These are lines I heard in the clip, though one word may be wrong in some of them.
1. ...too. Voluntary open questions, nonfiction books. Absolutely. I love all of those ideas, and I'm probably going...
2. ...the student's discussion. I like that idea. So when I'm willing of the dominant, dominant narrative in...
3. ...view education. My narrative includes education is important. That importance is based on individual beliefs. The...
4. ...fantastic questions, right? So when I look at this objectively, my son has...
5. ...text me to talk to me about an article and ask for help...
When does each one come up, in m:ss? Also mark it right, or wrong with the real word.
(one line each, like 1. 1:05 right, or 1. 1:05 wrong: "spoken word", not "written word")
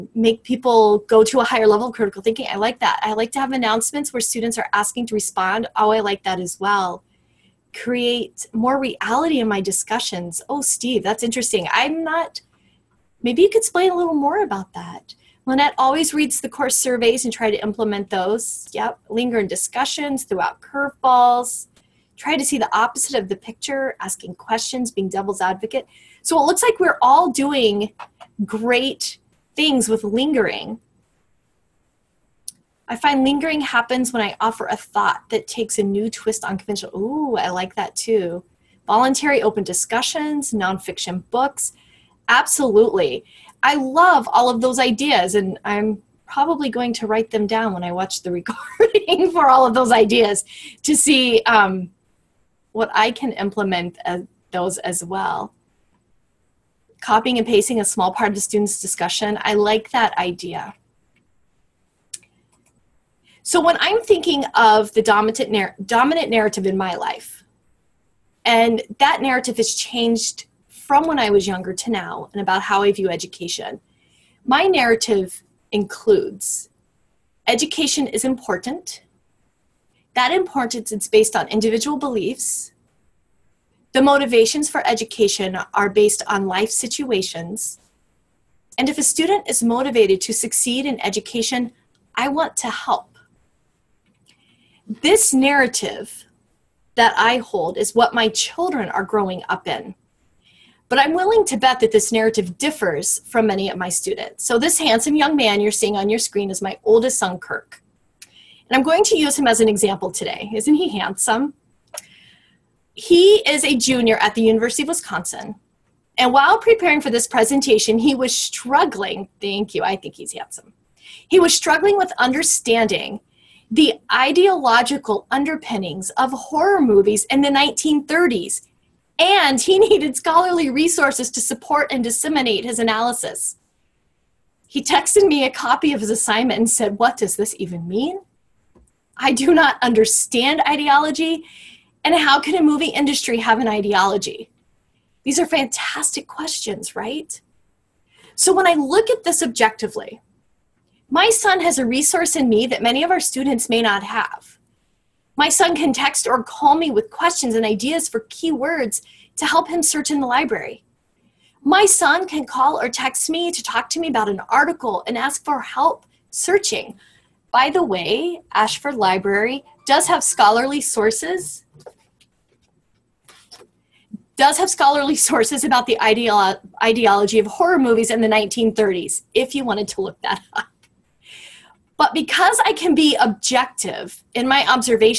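1. 0:37 wrong: "discussions", not "questions"
2. 0:58 wrong: "thinking", not "willing"
3. 1:12 right
4. 2:25 right
5. 2:42 right.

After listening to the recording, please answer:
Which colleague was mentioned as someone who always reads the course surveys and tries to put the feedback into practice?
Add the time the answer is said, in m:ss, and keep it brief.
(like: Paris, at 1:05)
Lynette, at 0:15.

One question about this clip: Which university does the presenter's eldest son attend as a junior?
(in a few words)
University of Wisconsin.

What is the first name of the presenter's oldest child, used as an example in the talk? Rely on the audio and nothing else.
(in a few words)
Kirk.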